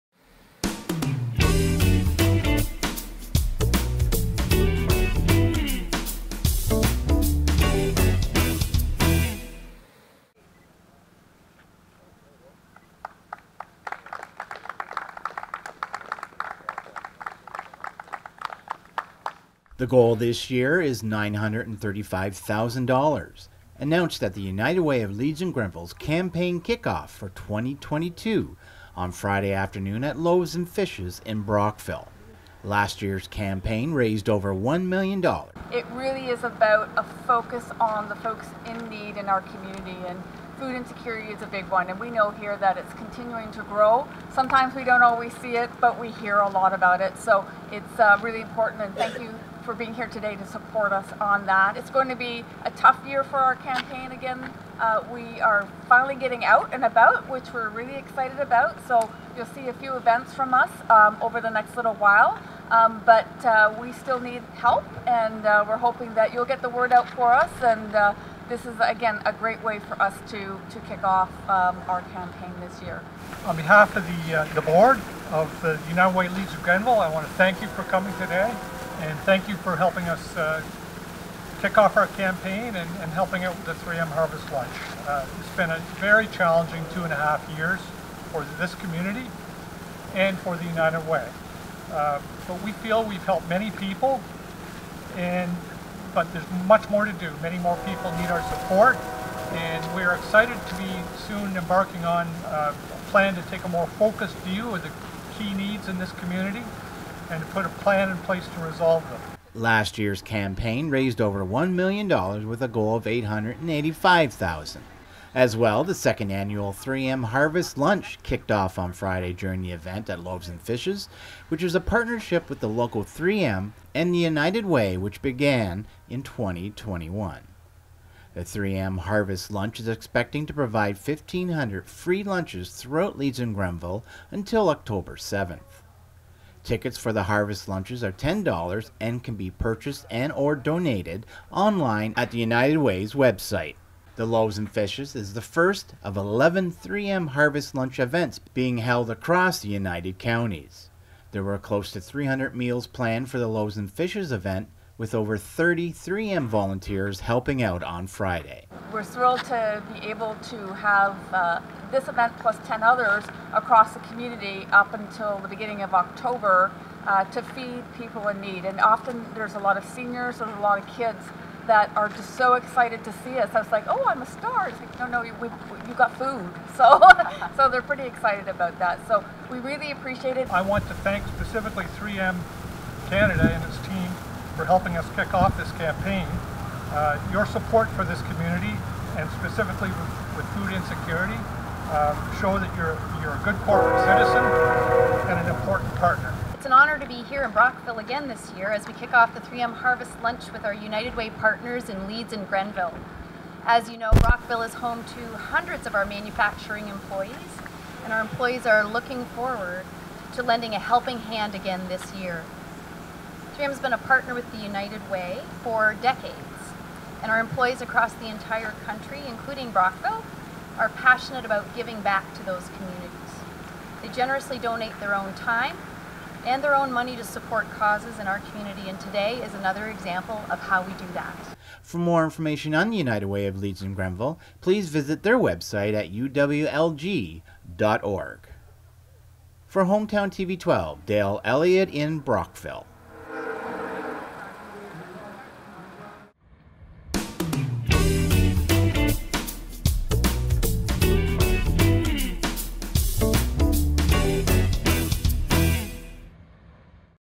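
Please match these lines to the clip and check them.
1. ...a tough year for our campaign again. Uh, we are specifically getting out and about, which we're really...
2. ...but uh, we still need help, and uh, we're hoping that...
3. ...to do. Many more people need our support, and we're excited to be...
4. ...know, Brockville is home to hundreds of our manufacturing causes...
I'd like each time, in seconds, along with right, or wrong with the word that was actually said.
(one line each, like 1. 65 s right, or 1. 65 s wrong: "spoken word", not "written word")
1. 52 s wrong: "finally", not "specifically"
2. 63 s right
3. 97 s right
4. 203 s wrong: "employees", not "causes".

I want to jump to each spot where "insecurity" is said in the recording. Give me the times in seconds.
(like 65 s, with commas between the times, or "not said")
40 s, 190 s.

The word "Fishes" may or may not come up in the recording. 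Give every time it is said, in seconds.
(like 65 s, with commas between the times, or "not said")
30 s, 120 s, 144 s, 153 s.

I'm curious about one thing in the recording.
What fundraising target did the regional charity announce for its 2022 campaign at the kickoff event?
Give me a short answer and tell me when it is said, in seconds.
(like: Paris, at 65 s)
$935,000, at 21 s.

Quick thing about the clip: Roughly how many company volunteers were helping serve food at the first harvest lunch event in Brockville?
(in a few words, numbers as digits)
over 30.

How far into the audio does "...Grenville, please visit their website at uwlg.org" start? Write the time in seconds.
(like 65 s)
233 s.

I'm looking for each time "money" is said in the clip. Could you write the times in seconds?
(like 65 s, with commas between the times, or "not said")
226 s.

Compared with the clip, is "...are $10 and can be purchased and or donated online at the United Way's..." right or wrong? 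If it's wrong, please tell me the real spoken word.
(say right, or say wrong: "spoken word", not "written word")
right.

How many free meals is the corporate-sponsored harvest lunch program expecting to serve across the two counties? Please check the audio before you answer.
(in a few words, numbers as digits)
1,500.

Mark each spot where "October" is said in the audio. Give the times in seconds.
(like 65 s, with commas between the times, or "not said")
134 s, 165 s.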